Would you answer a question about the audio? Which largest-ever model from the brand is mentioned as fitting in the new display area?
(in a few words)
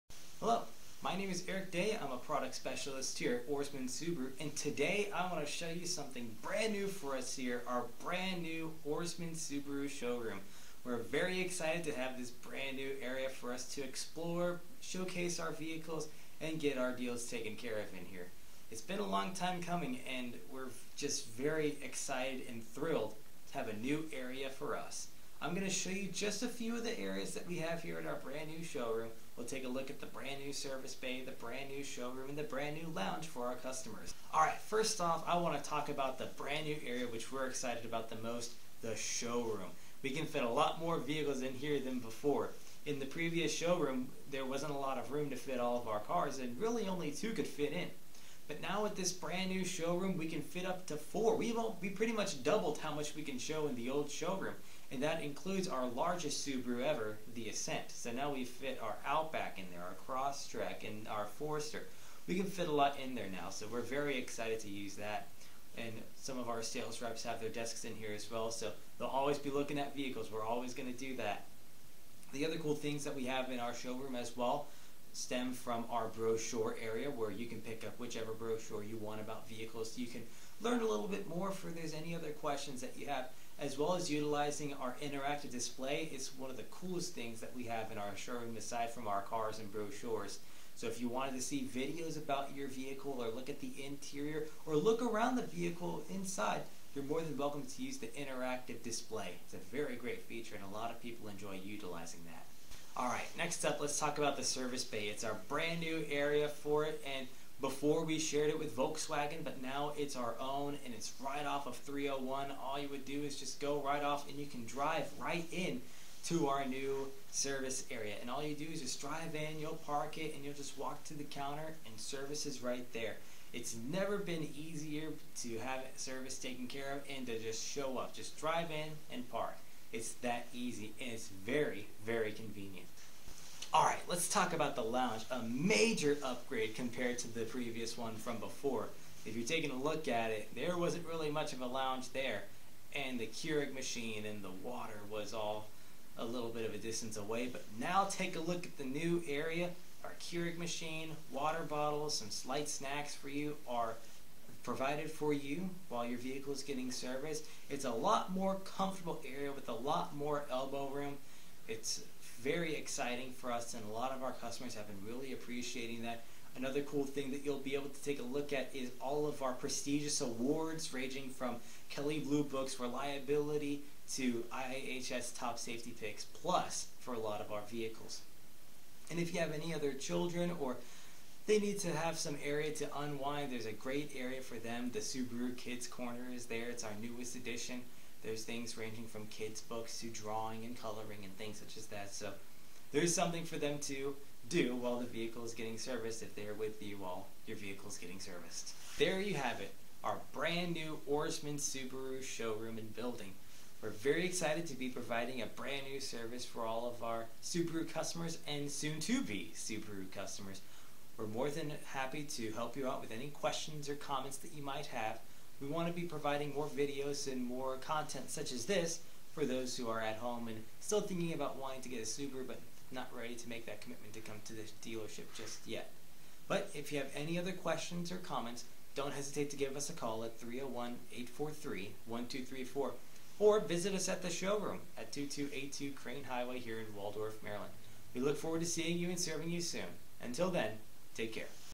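Ascent.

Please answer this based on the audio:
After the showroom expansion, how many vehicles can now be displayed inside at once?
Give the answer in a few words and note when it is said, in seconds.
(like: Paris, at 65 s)
4, at 50 s.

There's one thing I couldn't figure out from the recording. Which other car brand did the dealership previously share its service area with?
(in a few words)
Volkswagen.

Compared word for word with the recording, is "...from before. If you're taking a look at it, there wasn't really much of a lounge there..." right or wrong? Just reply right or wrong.
right.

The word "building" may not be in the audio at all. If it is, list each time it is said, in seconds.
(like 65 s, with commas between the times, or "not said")
202 s.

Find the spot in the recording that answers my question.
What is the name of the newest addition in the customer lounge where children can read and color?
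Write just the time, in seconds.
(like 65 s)
184 s.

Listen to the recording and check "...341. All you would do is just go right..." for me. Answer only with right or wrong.
wrong.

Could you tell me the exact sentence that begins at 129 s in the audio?
It's that easy, and it's very, very convenient.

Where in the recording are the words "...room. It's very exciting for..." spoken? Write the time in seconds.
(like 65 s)
160 s.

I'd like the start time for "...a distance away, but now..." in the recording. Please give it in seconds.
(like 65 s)
146 s.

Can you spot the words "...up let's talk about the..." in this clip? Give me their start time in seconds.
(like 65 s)
103 s.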